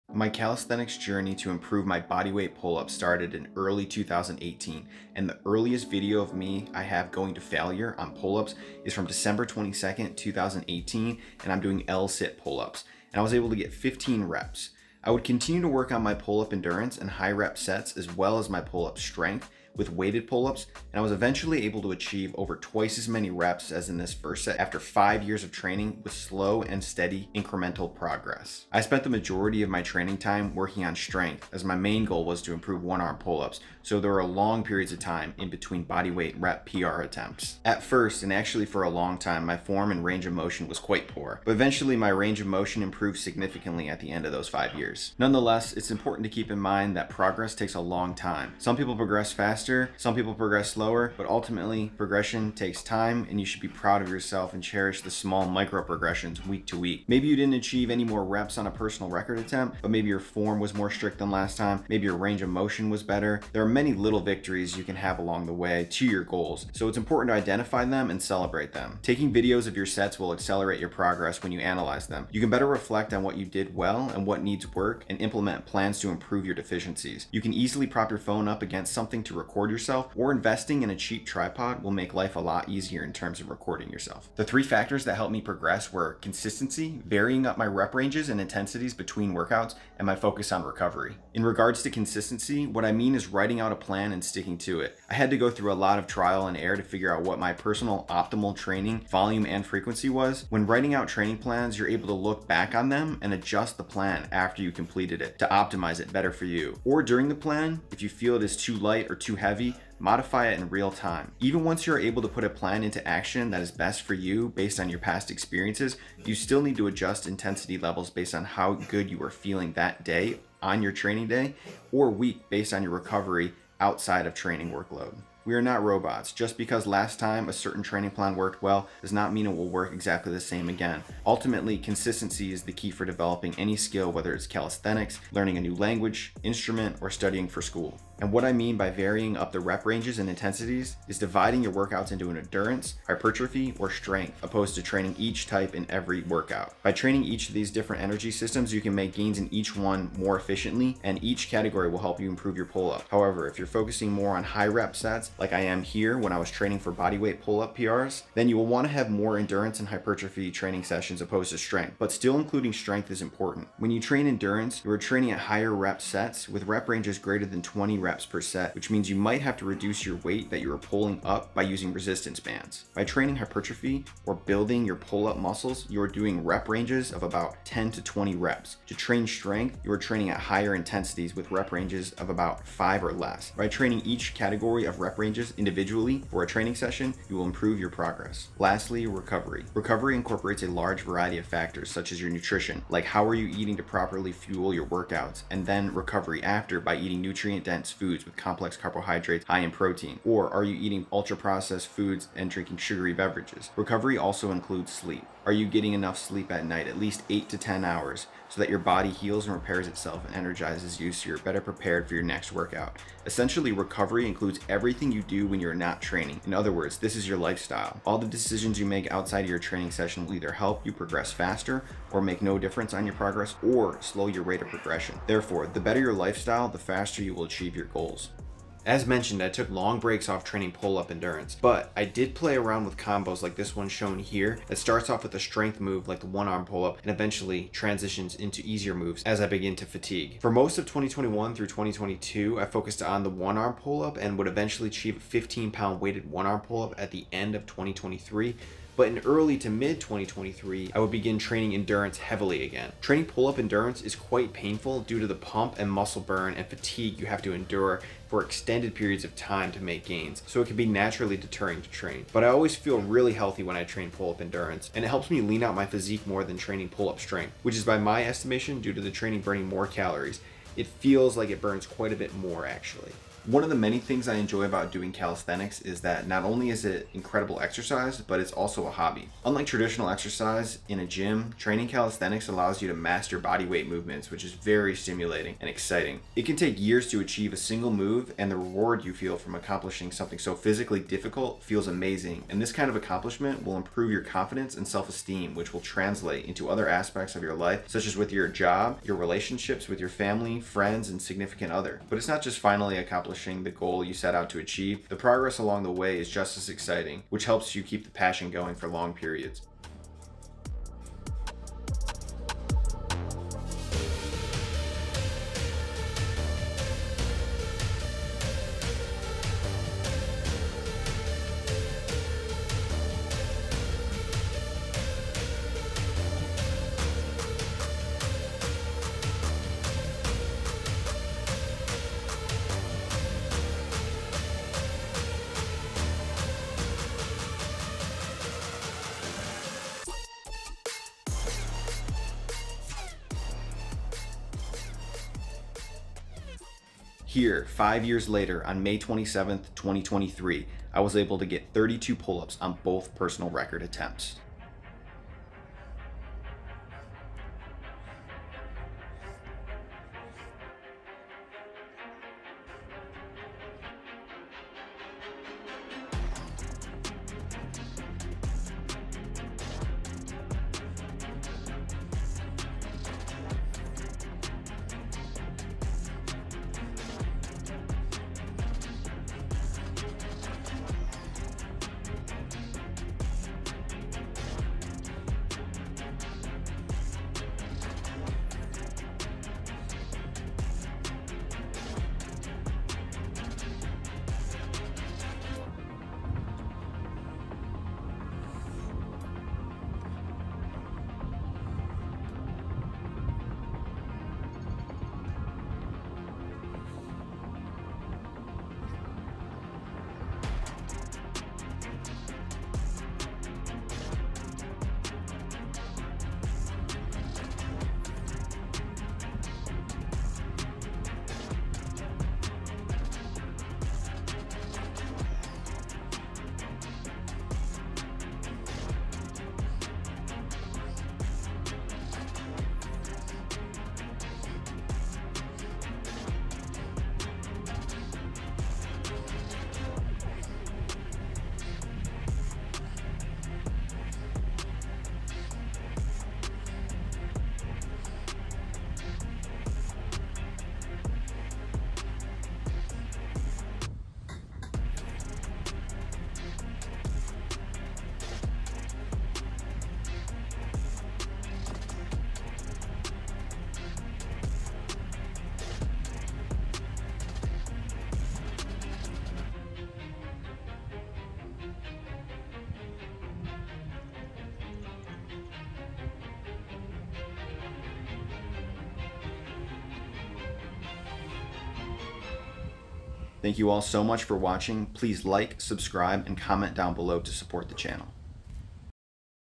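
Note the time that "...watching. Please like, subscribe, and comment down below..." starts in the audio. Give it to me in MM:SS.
08:04.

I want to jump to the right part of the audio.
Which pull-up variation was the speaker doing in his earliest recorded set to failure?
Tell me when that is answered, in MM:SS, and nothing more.
00:11.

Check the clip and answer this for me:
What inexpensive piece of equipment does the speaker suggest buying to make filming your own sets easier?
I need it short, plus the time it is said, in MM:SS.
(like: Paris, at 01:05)
cheap tripod, at 01:20.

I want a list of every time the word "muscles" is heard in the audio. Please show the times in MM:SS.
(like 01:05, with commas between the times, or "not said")
02:55, 04:15.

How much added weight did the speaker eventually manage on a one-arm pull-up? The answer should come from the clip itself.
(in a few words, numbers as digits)
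15 pounds.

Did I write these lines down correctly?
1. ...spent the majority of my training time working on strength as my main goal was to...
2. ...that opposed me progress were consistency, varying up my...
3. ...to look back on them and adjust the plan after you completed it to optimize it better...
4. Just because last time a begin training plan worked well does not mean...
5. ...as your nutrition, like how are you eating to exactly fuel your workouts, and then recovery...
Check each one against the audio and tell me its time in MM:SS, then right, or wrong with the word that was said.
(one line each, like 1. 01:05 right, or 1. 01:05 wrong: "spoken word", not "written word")
1. 00:28 right
2. 01:25 wrong: "helped", not "opposed"
3. 01:42 right
4. 02:06 wrong: "certain", not "begin"
5. 03:12 wrong: "properly", not "exactly".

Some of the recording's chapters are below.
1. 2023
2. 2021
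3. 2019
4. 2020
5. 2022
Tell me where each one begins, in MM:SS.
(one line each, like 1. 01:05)
1. 04:46
2. 03:02
3. 00:18
4. 00:30
5. 03:12.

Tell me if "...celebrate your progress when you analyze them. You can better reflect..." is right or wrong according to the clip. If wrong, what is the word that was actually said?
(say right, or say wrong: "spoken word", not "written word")
wrong: "accelerate", not "celebrate".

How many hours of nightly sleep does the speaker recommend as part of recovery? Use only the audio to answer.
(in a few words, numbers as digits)
8 to 10 hours.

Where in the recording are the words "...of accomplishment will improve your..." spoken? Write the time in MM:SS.
04:52.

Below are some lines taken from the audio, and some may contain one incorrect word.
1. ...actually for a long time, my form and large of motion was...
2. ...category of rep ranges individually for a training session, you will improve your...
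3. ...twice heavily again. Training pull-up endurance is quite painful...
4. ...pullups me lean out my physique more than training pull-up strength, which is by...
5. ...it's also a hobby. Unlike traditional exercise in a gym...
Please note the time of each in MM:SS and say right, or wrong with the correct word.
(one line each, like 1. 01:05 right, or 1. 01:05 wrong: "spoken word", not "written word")
1. 00:38 wrong: "range", not "large"
2. 03:04 right
3. 04:11 wrong: "endurance", not "twice"
4. 04:25 wrong: "helps", not "pullups"
5. 04:38 right.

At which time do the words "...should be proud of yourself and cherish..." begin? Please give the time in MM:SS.
00:53.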